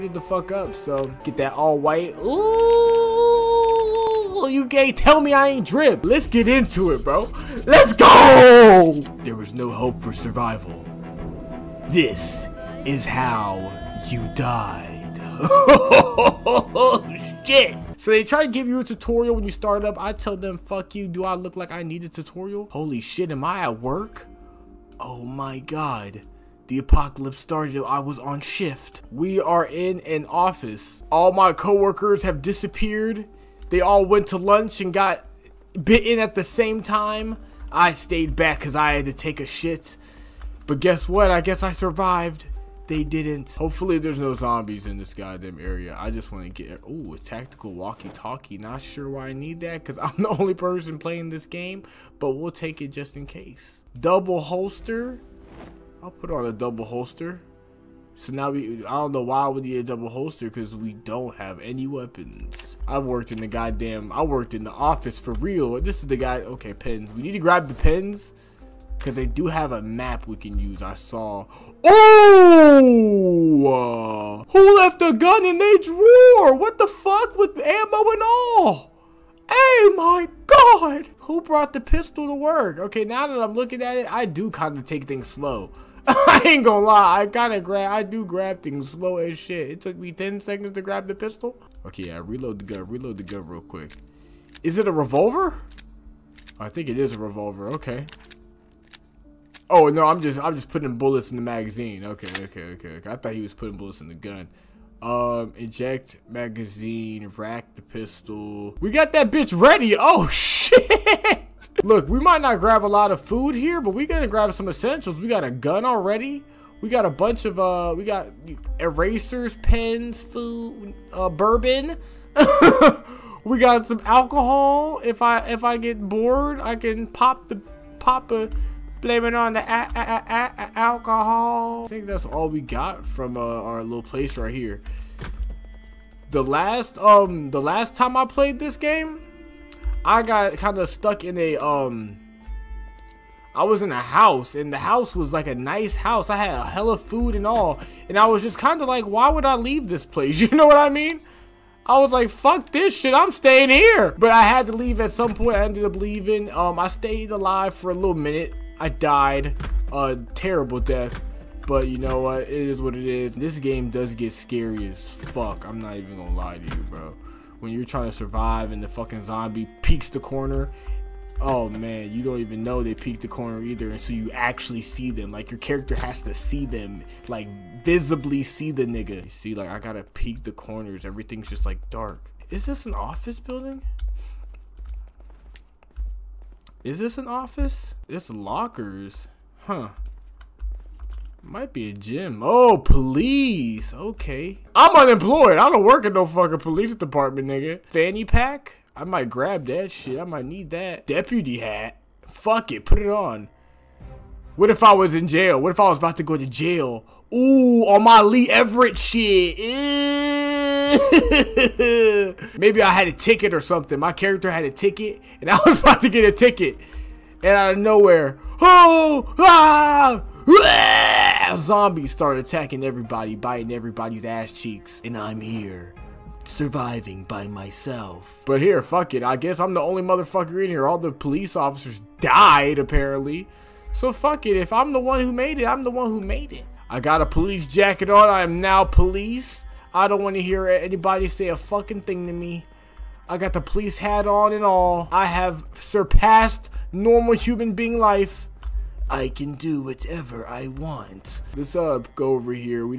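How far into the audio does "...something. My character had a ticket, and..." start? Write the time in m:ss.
3:33.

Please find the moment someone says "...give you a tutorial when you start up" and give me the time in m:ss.
0:18.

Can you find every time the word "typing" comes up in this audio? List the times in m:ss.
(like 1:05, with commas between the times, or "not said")
not said.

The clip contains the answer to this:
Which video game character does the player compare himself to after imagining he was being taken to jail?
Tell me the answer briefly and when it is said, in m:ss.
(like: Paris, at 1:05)
Lee Everett, at 3:28.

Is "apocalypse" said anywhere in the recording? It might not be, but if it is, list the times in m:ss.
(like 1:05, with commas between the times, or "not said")
0:26.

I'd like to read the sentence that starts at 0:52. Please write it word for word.
But we'll take it just in case.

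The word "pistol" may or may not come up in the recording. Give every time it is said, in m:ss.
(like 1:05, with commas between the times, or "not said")
1:21, 1:31, 1:47.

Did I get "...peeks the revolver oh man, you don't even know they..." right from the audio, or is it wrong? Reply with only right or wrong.
wrong.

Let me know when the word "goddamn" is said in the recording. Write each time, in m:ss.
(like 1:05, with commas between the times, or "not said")
0:45, 1:03.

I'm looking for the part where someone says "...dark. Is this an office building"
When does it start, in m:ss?
3:01.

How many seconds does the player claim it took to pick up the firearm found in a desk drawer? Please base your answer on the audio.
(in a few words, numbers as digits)
10.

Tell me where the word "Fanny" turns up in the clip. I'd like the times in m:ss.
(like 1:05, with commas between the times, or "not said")
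3:17.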